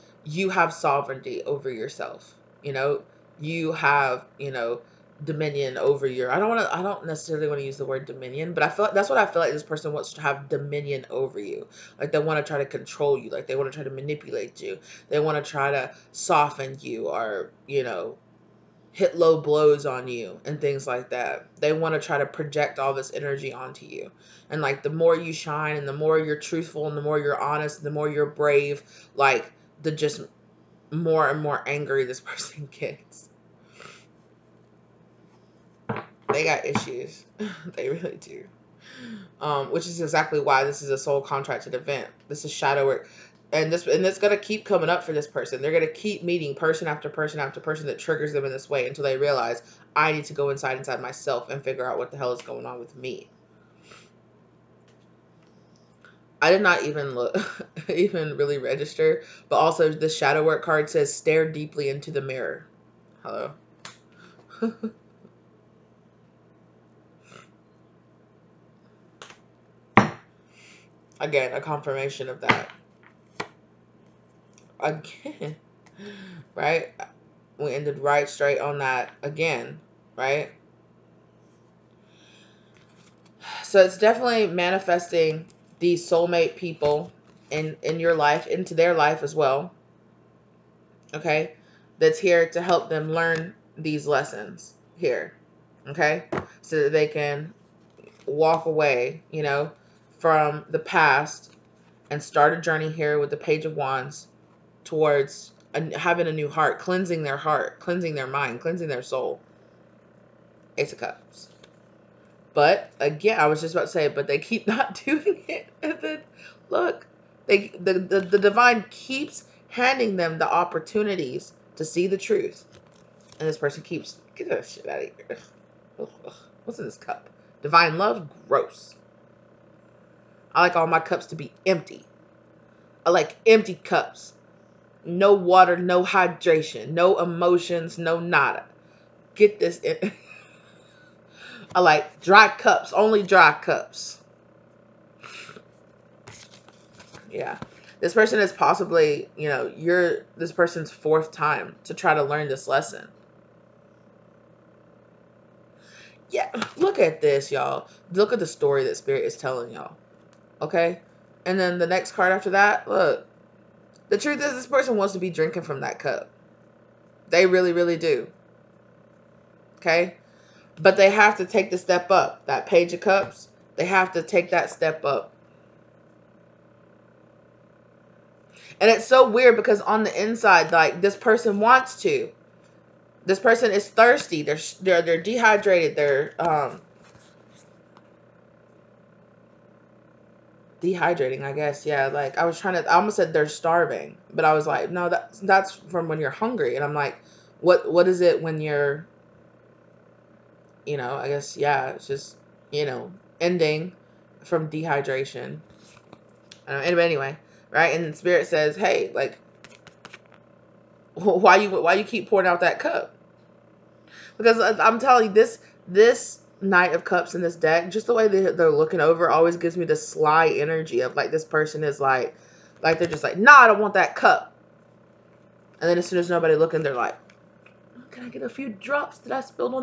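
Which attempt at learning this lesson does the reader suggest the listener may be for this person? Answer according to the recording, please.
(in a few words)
fourth.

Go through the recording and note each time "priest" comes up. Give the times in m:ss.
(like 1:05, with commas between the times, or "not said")
not said.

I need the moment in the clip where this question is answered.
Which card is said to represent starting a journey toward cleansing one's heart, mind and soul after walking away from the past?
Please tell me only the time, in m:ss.
1:43.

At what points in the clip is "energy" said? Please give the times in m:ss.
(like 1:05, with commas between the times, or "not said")
0:23, 3:40.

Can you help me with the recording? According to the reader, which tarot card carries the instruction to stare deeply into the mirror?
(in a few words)
Shadow work card.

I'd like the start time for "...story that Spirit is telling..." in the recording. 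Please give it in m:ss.
2:38.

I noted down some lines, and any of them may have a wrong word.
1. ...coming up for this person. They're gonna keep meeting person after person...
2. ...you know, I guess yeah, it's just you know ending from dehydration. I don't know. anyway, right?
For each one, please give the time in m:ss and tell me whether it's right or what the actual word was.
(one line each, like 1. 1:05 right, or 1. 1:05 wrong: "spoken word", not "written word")
1. 0:44 right
2. 3:20 right.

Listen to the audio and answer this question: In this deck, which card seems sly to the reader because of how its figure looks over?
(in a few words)
Knight of Cups.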